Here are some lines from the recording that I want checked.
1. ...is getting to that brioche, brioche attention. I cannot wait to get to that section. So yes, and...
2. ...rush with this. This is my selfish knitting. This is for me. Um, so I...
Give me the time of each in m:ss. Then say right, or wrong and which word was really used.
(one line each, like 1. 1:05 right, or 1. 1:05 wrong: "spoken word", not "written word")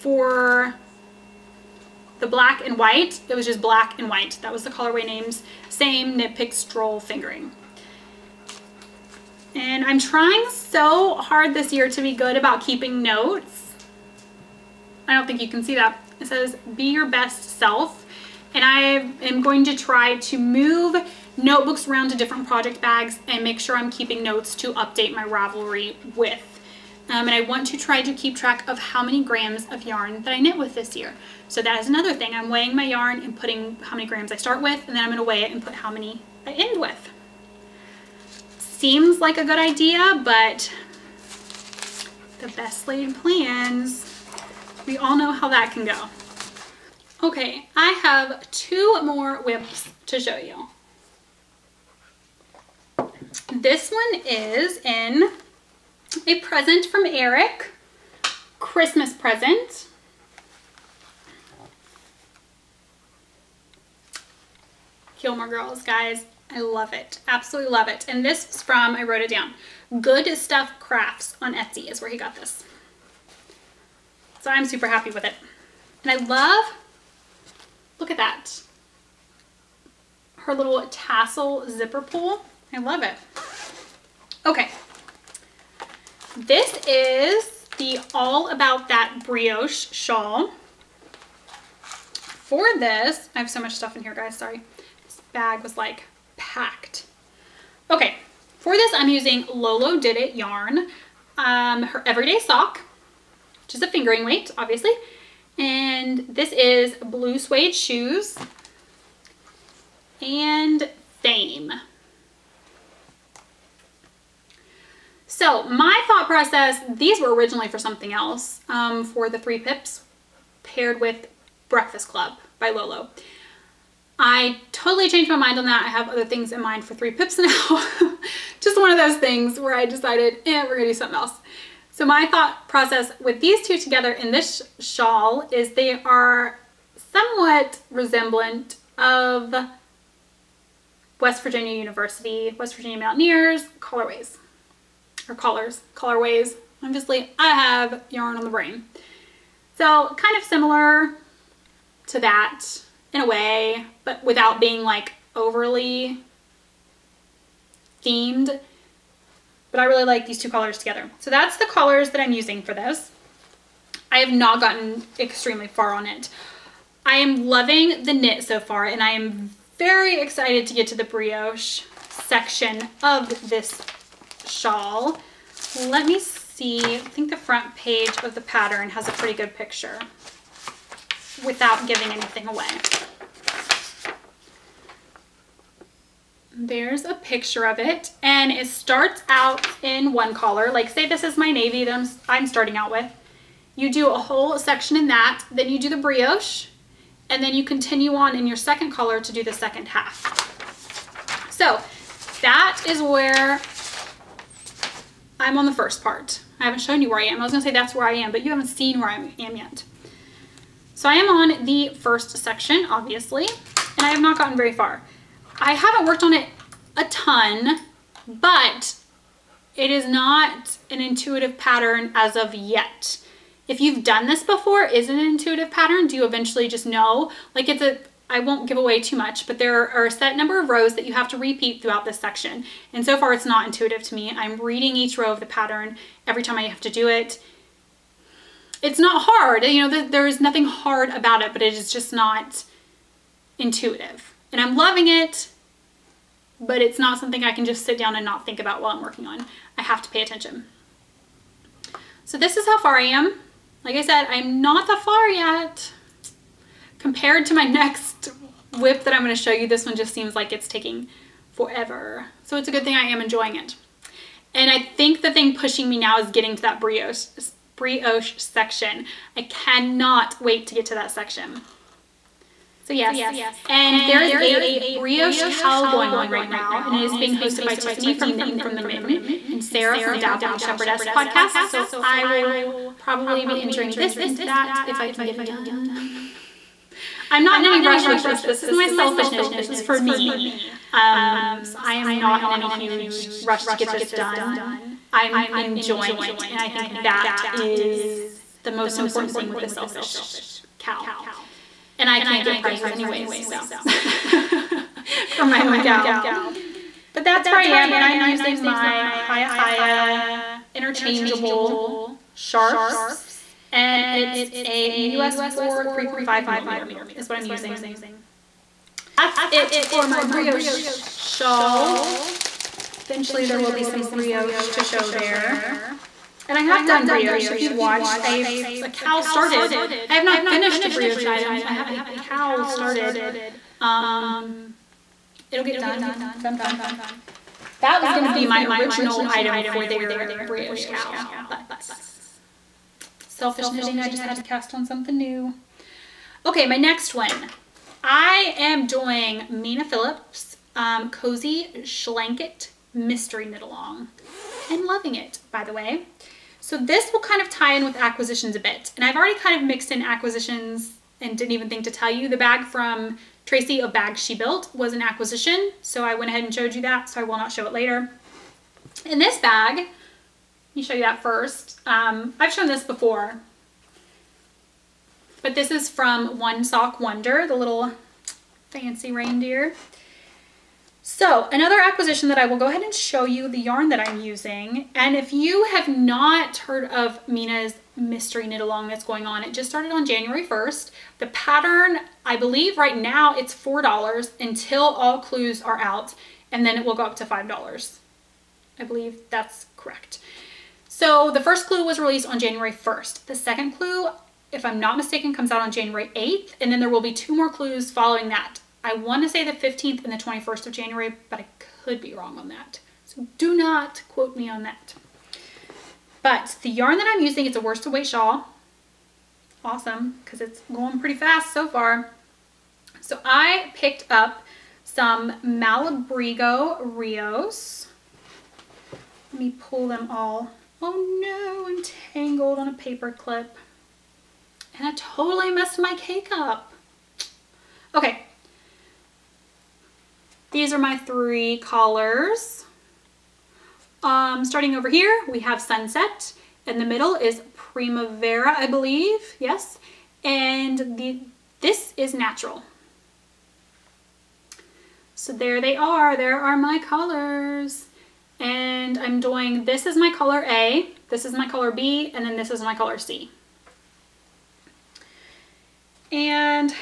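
1. 4:26 wrong: "section", not "attention"
2. 4:47 right.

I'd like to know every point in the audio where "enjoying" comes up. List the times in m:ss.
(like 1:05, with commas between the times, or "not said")
4:23, 4:55.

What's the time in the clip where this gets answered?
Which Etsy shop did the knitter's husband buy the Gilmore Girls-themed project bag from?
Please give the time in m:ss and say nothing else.
1:10.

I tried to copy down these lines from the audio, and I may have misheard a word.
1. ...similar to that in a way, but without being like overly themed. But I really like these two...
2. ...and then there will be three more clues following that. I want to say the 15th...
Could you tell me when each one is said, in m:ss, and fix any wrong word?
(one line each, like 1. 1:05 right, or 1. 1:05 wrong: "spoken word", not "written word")
1. 2:30 right
2. 6:46 wrong: "two", not "three".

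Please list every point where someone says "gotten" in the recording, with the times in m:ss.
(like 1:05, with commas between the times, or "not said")
2:44, 3:34.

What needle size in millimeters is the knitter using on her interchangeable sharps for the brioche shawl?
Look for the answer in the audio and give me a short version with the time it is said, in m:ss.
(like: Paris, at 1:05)
3.5 millimeter, at 5:15.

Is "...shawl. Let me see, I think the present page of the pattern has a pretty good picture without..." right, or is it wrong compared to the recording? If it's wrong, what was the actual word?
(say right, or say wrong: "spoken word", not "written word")
wrong: "front", not "present".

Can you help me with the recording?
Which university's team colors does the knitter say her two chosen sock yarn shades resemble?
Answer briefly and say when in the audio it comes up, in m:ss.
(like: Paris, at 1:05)
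West Virginia University, at 2:21.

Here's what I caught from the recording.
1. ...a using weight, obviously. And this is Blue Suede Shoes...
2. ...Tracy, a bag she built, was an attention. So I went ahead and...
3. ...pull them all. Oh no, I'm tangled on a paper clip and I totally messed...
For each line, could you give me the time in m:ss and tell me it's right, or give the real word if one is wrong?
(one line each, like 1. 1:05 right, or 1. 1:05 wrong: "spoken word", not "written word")
1. 1:43 wrong: "fingering", not "using"
2. 6:03 wrong: "acquisition", not "attention"
3. 7:09 right.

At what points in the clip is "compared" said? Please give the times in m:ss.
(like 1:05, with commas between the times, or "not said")
4:17.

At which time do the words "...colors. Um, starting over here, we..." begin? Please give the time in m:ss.
7:21.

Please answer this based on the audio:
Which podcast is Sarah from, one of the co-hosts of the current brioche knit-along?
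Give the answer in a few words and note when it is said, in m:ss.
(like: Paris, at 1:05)
Dabbling Shepherdess, at 4:40.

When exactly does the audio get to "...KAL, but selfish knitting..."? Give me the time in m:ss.
5:40.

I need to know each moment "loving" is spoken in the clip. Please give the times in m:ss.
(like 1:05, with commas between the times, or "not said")
2:47, 4:04, 5:54.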